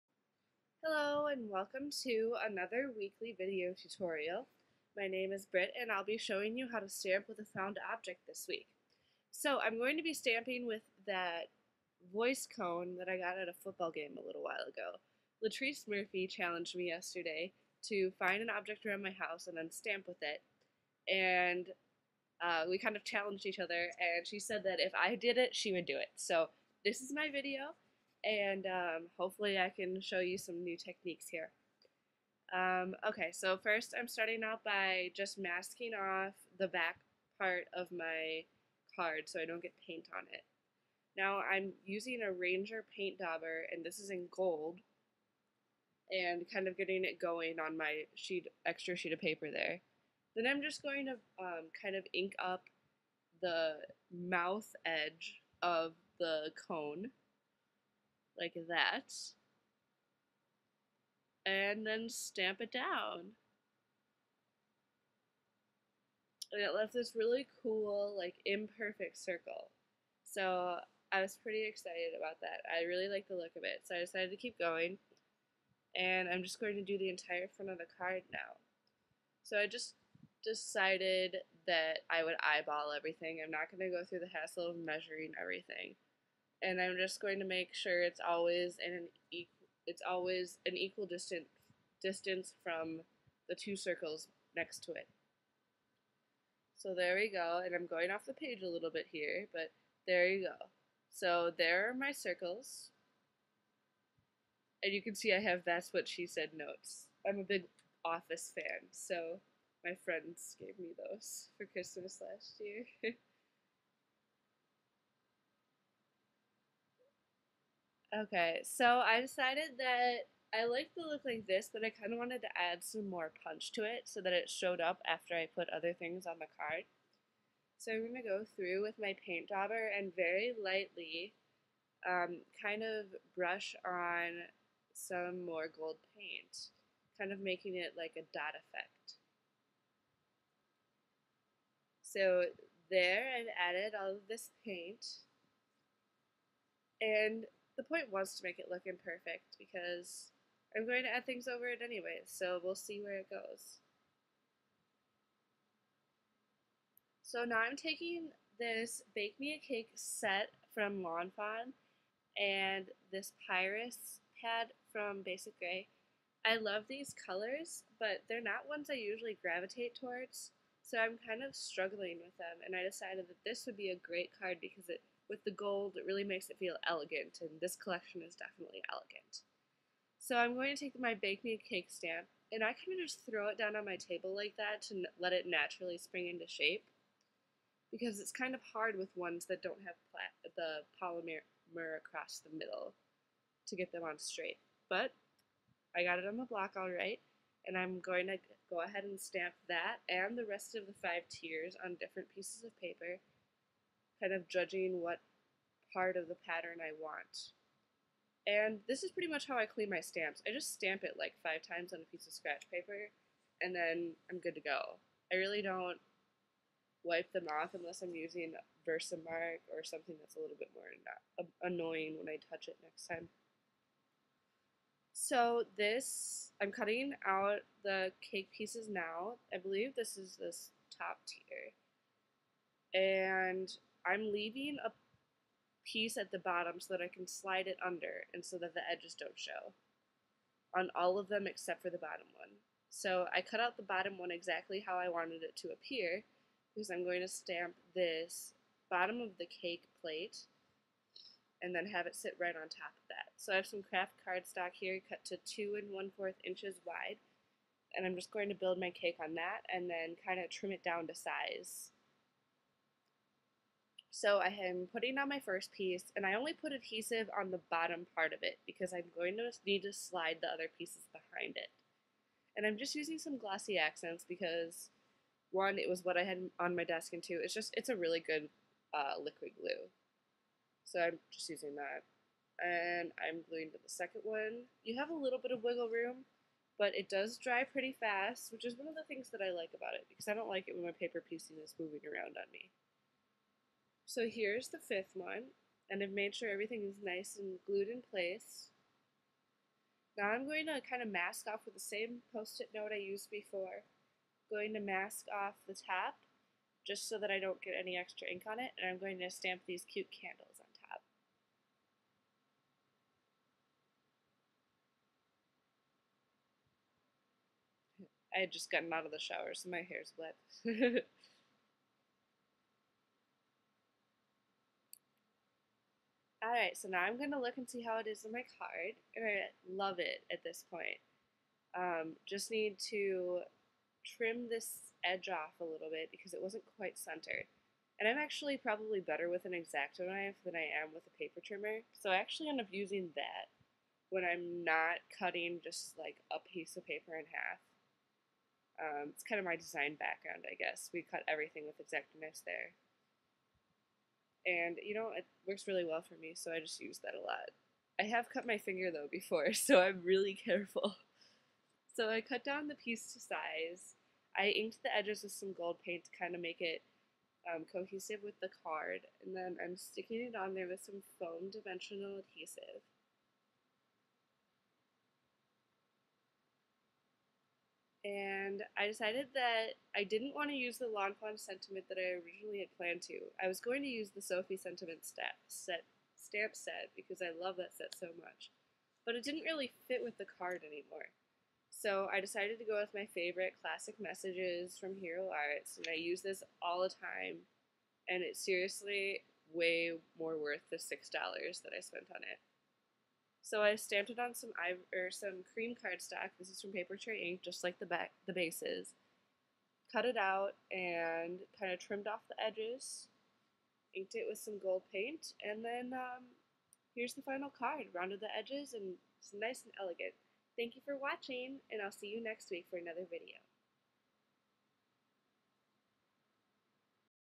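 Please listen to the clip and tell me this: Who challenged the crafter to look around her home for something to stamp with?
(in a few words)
Latrice Murphy.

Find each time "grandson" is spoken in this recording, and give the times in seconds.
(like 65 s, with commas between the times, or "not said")
not said.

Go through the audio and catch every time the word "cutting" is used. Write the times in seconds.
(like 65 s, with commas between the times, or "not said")
226 s, 345 s.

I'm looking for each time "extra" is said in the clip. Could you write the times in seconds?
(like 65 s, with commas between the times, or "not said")
48 s, 307 s.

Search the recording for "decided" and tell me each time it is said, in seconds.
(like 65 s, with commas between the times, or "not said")
73 s, 80 s, 119 s, 172 s, 378 s, 392 s.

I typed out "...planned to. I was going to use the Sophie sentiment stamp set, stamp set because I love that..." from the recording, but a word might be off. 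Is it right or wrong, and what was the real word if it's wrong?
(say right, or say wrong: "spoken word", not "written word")
right.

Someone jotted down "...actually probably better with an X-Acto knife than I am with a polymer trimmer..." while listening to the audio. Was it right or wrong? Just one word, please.
wrong.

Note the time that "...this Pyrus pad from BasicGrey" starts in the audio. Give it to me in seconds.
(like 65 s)
163 s.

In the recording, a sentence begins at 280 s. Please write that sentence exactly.
So I'm just using that and I'm gluing to the second one.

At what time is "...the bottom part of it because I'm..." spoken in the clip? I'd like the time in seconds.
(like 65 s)
267 s.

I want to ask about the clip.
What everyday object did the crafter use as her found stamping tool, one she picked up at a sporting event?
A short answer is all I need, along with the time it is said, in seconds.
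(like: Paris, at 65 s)
voice cone, at 12 s.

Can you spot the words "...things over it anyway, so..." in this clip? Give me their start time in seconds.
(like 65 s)
151 s.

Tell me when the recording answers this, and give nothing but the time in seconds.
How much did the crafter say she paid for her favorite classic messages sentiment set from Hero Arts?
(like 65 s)
400 s.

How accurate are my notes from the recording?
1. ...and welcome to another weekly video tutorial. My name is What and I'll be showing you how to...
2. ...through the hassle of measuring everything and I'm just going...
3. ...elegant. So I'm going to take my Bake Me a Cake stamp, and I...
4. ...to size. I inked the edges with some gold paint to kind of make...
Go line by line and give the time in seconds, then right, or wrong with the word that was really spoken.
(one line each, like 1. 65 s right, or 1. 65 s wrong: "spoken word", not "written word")
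1. 1 s wrong: "Britt", not "What"
2. 84 s right
3. 178 s right
4. 363 s right.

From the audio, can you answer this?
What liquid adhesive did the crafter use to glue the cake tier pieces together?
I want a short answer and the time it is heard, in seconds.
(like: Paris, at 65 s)
Glossy Accents, at 273 s.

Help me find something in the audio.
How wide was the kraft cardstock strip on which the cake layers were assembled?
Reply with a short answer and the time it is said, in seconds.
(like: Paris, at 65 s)
2 and 1/4 inches, at 255 s.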